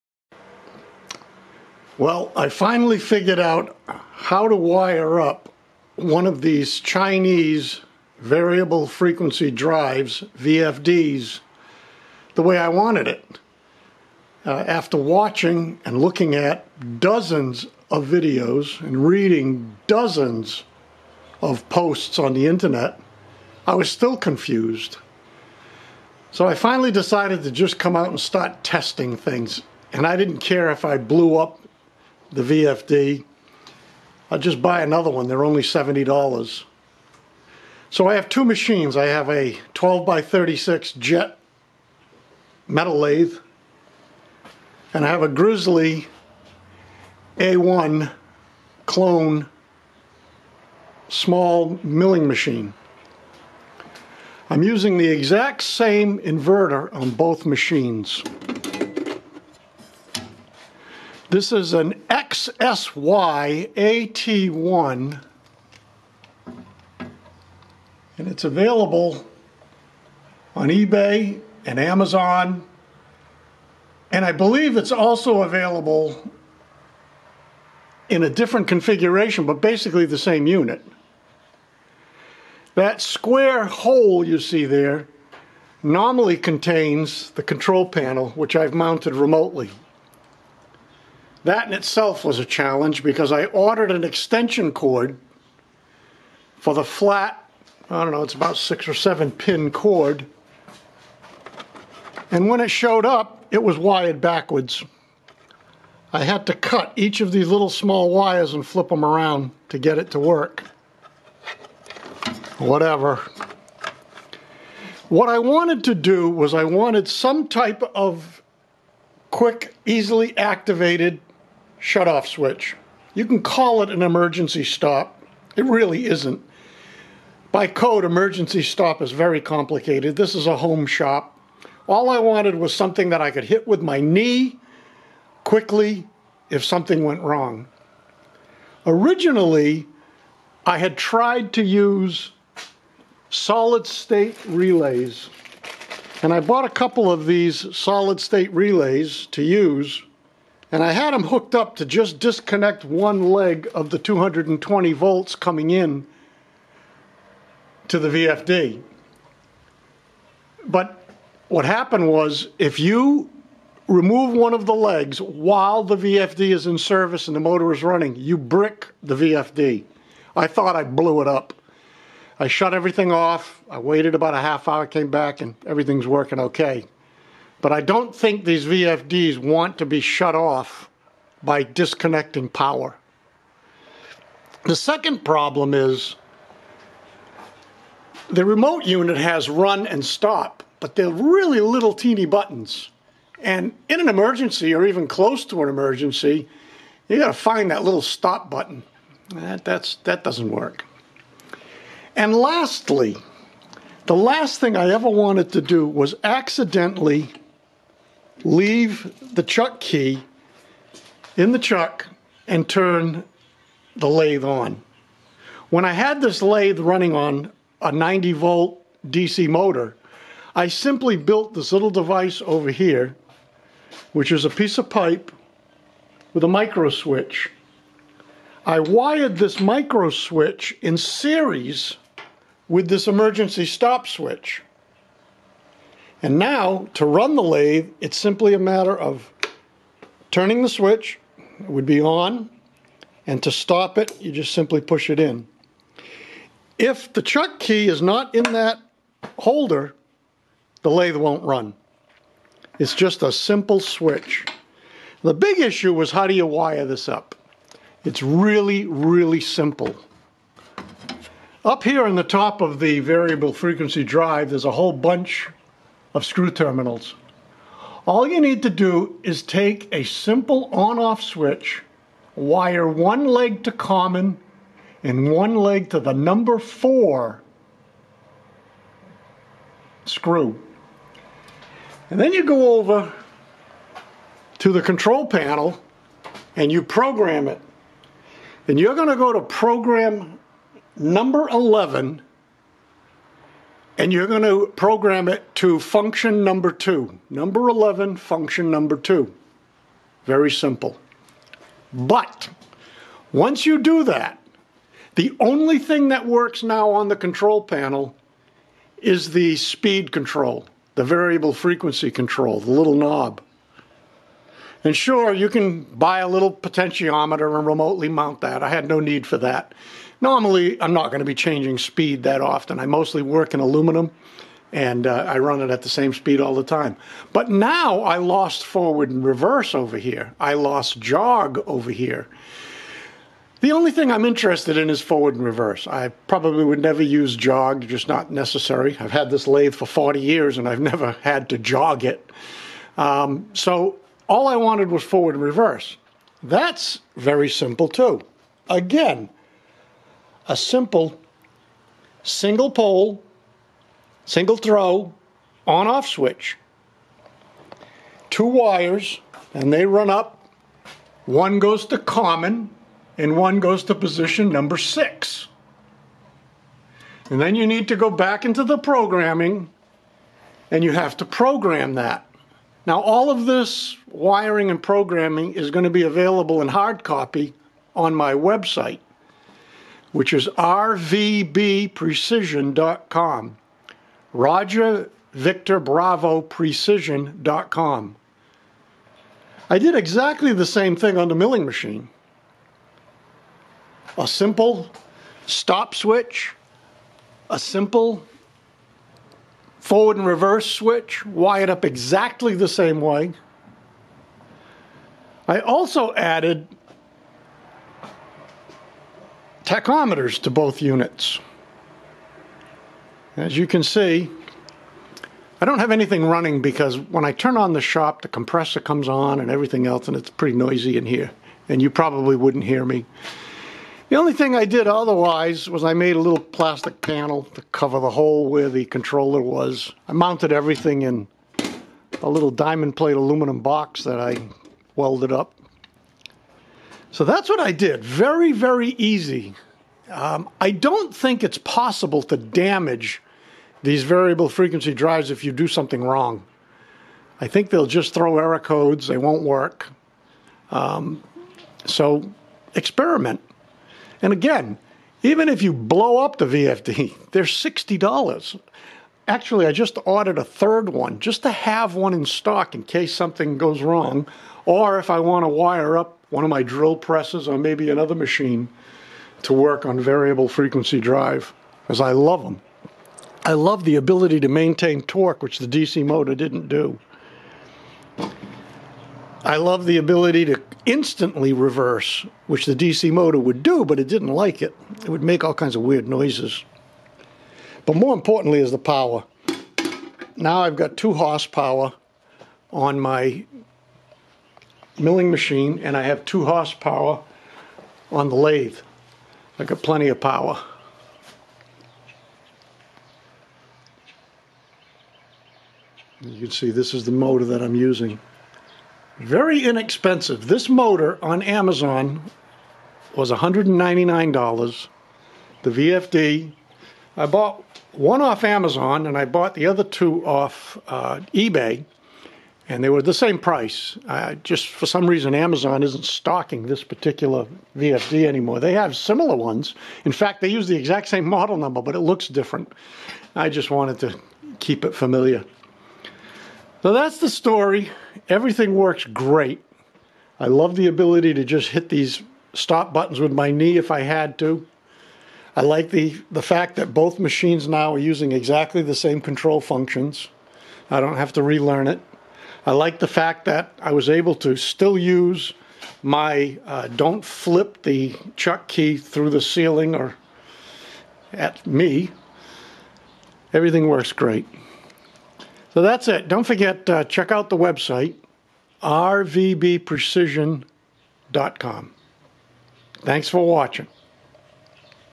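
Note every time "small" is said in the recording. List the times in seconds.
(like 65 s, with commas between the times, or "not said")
51 s, 107 s.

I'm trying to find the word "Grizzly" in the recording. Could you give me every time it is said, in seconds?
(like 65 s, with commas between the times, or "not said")
45 s.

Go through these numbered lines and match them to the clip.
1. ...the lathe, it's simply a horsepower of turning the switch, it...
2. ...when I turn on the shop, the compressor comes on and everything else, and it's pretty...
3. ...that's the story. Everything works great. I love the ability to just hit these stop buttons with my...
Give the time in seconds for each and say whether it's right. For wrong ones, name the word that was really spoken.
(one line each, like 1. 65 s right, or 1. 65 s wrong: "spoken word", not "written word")
1. 237 s wrong: "matter", not "horsepower"
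2. 416 s right
3. 536 s right.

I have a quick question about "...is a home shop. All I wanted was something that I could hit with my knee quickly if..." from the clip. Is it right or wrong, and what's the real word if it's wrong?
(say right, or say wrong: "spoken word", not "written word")
right.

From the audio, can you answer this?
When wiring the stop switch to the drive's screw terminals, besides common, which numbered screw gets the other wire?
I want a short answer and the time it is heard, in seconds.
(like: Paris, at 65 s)
4, at 276 s.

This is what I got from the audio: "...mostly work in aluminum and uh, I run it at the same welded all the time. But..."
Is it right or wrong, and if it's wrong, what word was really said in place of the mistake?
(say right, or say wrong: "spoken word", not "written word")
wrong: "speed", not "welded".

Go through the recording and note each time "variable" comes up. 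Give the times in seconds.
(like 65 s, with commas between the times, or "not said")
8 s, 262 s, 311 s, 444 s, 469 s.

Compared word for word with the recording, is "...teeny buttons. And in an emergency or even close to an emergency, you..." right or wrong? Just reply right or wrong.
right.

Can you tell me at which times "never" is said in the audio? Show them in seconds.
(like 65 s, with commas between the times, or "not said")
336 s, 340 s.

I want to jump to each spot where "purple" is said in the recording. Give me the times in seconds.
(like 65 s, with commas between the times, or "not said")
not said.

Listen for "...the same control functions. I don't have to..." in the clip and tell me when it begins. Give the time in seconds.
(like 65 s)
548 s.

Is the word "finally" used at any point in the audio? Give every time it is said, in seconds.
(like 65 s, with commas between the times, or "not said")
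2 s, 26 s.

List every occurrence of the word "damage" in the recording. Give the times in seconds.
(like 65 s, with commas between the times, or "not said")
442 s.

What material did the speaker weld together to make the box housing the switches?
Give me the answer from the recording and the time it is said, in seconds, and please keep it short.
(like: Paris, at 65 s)
diamond plate aluminum, at 432 s.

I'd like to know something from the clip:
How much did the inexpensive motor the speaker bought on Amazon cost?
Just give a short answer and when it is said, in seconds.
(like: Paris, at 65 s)
$199, at 513 s.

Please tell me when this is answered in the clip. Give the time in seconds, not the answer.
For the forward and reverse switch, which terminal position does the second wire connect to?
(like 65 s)
363 s.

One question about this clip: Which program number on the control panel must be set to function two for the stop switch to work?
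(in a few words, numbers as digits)
11.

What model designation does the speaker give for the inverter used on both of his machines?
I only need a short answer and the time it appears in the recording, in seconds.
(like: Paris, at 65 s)
XSYAT1, at 62 s.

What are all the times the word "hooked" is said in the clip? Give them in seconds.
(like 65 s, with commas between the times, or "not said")
151 s.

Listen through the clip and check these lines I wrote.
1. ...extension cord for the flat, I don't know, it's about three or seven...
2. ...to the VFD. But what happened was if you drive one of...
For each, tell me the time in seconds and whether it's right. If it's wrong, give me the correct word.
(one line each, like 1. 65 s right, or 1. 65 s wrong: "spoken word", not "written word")
1. 94 s wrong: "six", not "three"
2. 157 s wrong: "remove", not "drive".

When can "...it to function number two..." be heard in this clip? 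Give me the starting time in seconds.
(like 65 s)
295 s.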